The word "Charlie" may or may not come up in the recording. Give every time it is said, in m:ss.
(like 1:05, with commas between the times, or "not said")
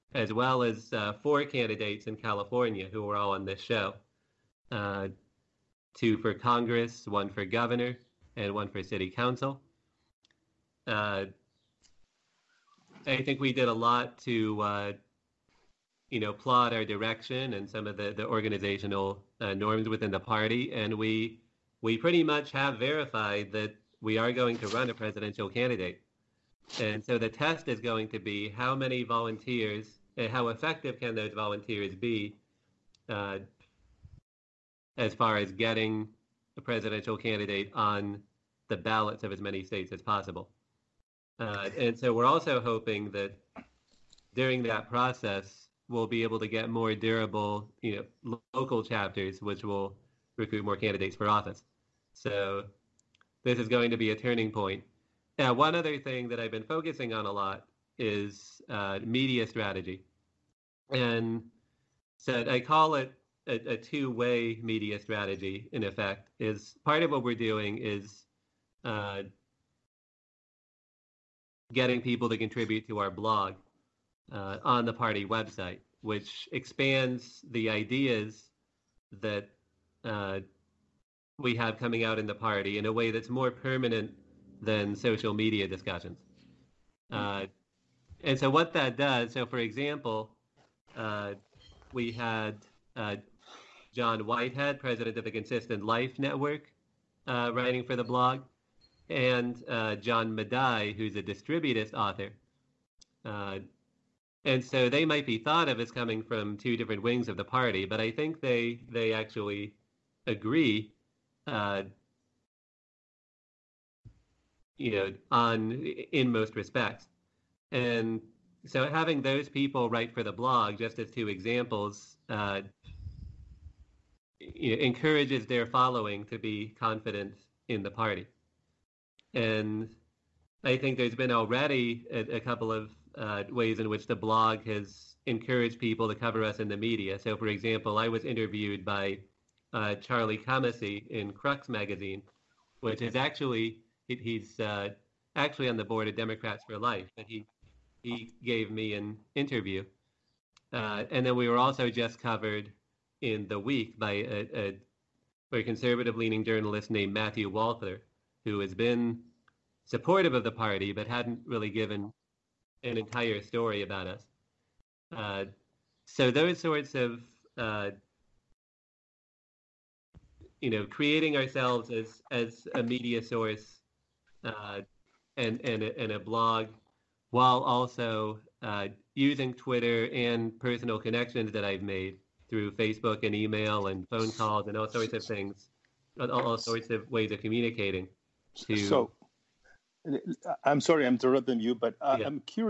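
2:19.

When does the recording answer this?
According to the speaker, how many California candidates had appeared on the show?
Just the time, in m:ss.
0:01.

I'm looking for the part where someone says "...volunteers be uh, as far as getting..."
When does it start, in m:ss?
0:31.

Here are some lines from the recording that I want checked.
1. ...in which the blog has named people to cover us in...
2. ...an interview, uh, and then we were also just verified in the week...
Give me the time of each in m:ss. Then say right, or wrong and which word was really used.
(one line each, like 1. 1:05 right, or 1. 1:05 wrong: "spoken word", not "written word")
1. 2:13 wrong: "encouraged", not "named"
2. 2:28 wrong: "covered", not "verified".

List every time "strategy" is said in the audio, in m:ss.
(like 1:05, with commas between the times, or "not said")
0:59, 1:04.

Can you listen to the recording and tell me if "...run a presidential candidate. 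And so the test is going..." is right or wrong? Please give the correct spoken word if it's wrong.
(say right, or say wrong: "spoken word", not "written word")
right.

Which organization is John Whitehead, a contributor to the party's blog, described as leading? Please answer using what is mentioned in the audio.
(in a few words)
Consistent Life Network.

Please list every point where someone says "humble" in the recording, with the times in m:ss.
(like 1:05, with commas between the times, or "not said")
not said.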